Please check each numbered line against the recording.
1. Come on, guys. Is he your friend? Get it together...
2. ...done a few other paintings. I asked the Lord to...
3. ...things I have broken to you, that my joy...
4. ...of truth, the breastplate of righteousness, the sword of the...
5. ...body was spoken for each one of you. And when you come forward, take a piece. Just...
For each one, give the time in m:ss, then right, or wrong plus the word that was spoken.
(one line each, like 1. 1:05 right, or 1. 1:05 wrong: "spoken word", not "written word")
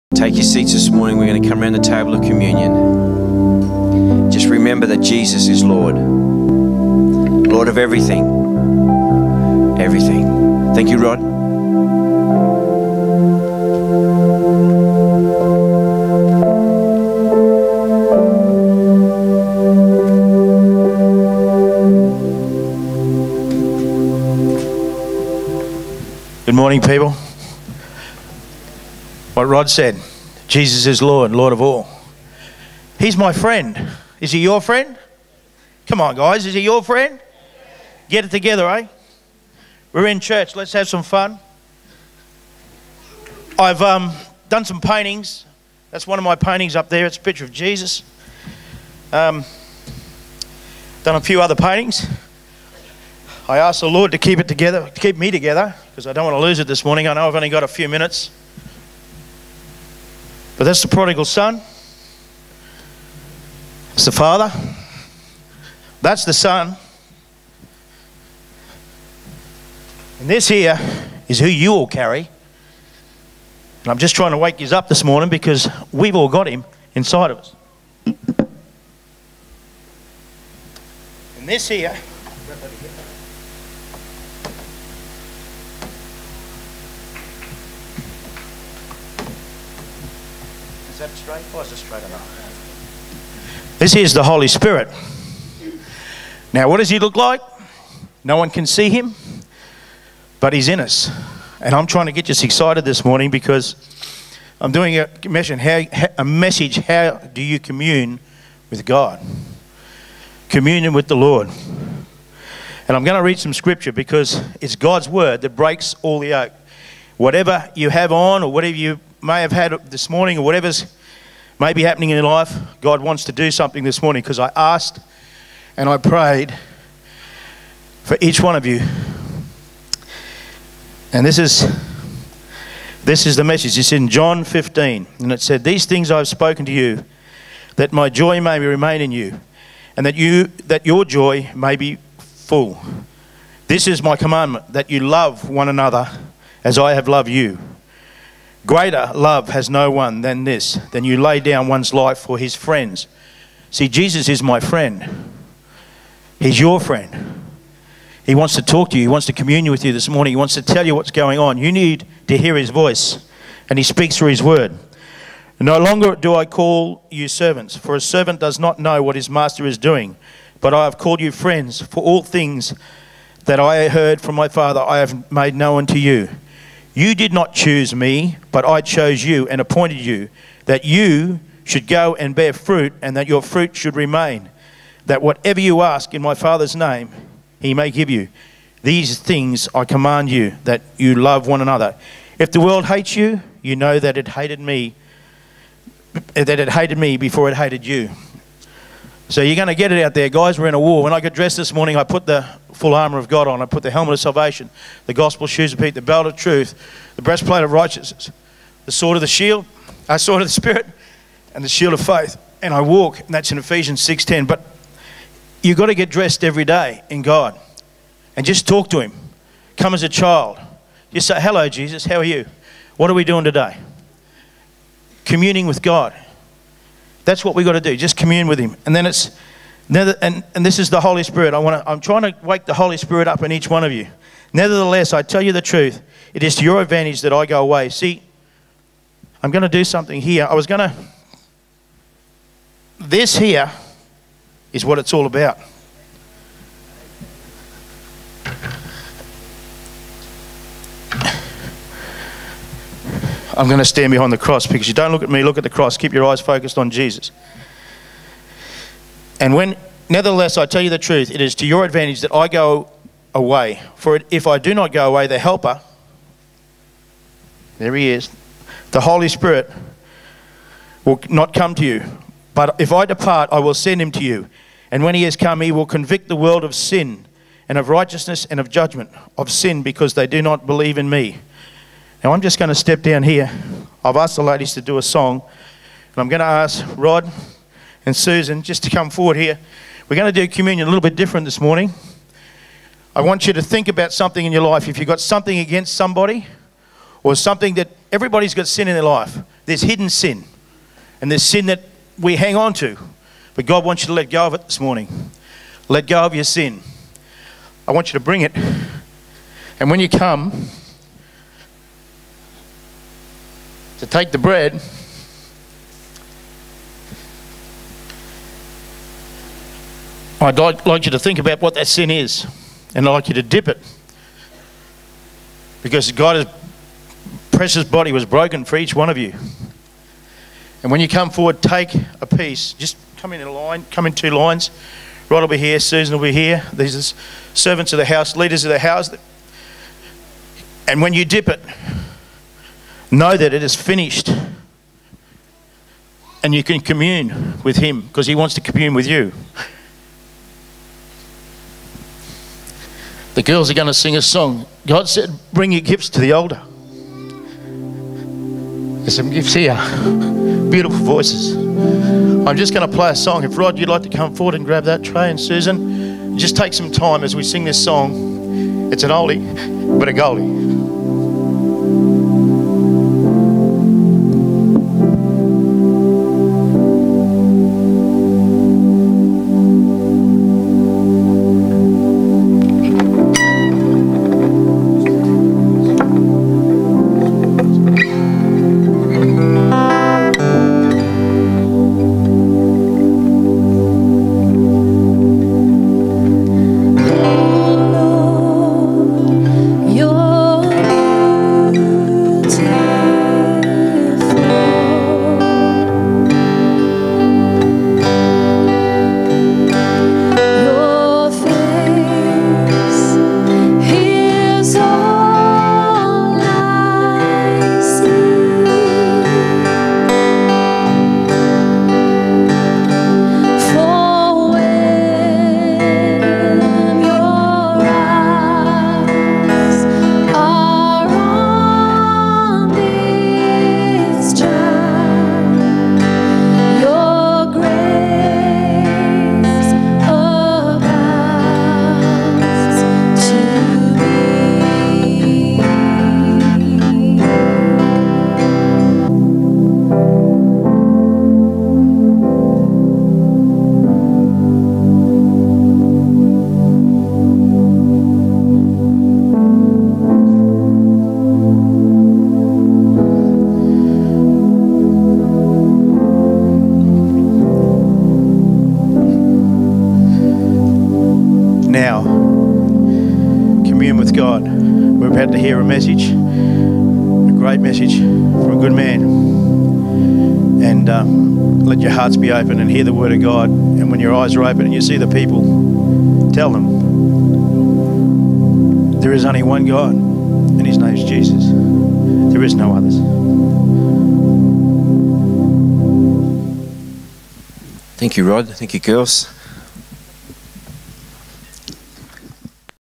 1. 0:35 right
2. 0:51 right
3. 2:15 wrong: "spoken", not "broken"
4. 3:26 right
5. 5:27 wrong: "broken", not "spoken".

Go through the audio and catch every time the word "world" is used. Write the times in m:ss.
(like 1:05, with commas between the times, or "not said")
3:12, 4:36.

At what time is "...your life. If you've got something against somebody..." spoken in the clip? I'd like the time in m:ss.
4:54.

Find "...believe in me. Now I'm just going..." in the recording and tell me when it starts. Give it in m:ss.
4:40.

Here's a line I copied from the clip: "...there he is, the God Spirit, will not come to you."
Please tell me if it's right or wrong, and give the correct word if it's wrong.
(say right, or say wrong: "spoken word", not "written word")
wrong: "Holy", not "God".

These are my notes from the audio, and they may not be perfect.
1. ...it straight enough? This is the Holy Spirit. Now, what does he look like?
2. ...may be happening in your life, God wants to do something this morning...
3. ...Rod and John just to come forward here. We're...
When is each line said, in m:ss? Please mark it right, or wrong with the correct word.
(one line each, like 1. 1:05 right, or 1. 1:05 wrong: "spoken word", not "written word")
1. 1:31 right
2. 2:01 right
3. 4:46 wrong: "Susan", not "John".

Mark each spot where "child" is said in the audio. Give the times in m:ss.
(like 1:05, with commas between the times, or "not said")
3:40.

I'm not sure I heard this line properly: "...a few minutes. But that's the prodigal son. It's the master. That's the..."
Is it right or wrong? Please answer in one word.
wrong.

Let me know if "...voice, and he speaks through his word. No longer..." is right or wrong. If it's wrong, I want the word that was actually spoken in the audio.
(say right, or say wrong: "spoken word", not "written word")
right.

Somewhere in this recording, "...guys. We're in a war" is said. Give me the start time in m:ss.
3:20.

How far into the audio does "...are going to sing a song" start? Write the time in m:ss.
5:53.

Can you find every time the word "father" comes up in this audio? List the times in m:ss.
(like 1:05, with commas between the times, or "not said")
1:04, 2:54, 3:06.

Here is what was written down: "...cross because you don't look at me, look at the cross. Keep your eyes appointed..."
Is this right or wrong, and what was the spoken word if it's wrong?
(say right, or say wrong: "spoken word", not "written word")
wrong: "focused", not "appointed".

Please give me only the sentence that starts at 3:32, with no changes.
And I walk, and that's in Ephesians 6:10.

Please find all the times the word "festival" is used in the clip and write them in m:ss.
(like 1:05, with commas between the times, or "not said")
not said.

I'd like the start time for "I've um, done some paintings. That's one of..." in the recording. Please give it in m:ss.
0:43.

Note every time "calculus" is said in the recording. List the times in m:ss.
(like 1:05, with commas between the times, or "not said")
not said.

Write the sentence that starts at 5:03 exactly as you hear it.
But God wants you to let go of it this morning.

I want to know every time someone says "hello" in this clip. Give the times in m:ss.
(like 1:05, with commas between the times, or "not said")
3:41.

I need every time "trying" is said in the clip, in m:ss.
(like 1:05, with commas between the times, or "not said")
1:14, 1:41, 3:51.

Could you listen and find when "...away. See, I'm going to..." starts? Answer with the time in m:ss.
3:57.